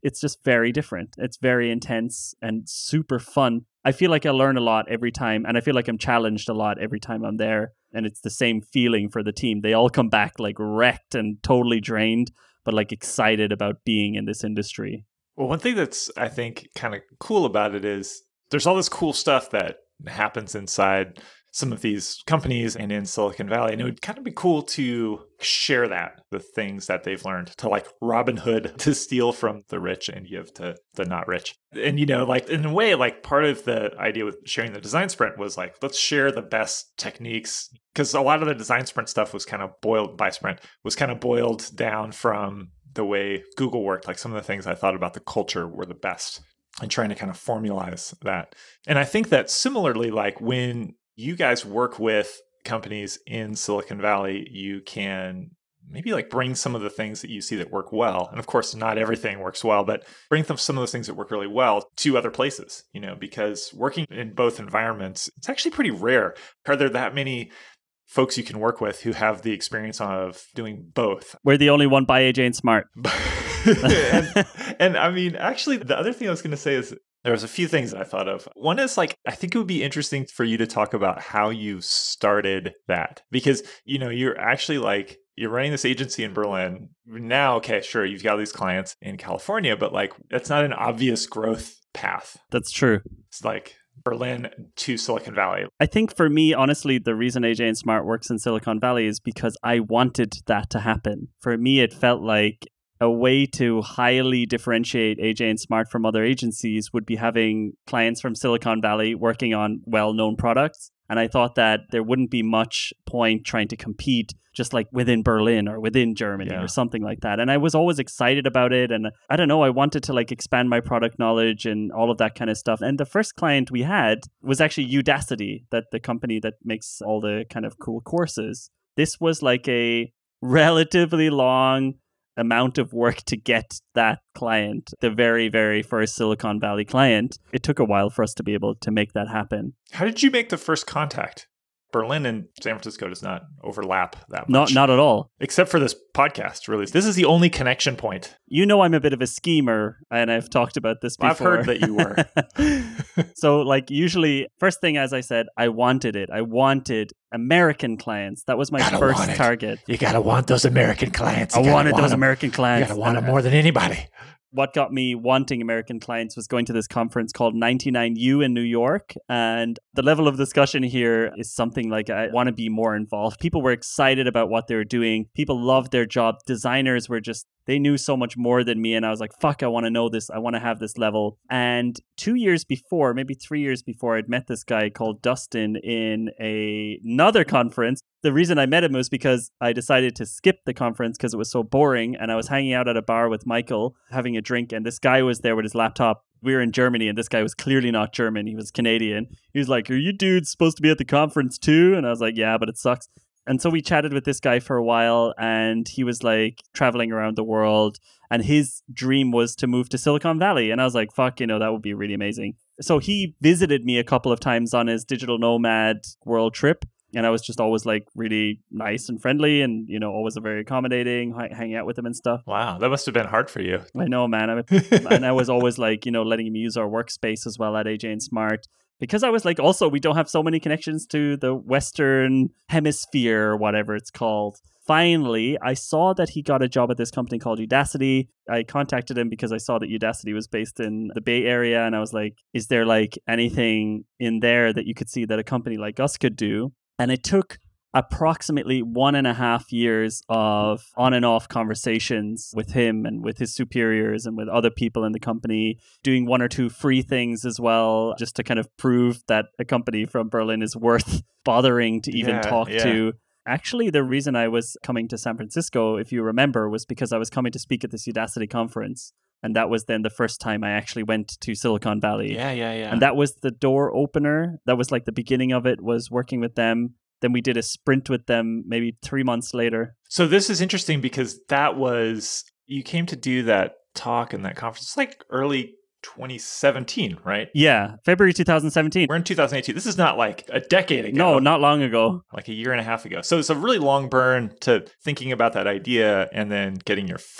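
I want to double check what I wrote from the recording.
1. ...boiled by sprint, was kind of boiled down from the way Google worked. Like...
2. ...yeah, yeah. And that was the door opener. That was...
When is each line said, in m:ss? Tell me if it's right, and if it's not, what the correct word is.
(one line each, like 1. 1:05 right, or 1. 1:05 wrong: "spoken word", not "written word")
1. 0:39 right
2. 4:32 right.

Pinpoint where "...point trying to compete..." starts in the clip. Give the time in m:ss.
1:53.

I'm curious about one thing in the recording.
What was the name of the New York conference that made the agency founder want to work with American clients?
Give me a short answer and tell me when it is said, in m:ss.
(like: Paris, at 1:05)
99U, at 2:47.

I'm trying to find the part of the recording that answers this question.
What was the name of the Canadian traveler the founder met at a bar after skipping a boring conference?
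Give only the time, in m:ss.
3:05.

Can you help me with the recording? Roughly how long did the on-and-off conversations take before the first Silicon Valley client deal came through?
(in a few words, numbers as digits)
one and a half years.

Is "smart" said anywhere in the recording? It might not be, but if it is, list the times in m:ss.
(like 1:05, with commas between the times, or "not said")
1:12, 1:37, 1:45, 3:48.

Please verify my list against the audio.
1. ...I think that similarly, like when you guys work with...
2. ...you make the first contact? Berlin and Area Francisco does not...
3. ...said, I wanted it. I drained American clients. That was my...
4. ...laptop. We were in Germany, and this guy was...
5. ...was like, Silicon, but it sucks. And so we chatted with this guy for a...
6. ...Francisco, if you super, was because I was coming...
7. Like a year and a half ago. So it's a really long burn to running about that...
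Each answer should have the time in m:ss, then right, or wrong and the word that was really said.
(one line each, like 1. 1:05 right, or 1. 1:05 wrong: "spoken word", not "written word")
1. 0:48 right
2. 2:20 wrong: "San", not "Area"
3. 2:35 wrong: "wanted", not "drained"
4. 3:15 right
5. 3:22 wrong: "Yeah", not "Silicon"
6. 4:25 wrong: "remember", not "super"
7. 4:52 wrong: "thinking", not "running".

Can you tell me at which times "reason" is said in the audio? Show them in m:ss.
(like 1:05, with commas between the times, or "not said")
1:37, 3:08, 4:24.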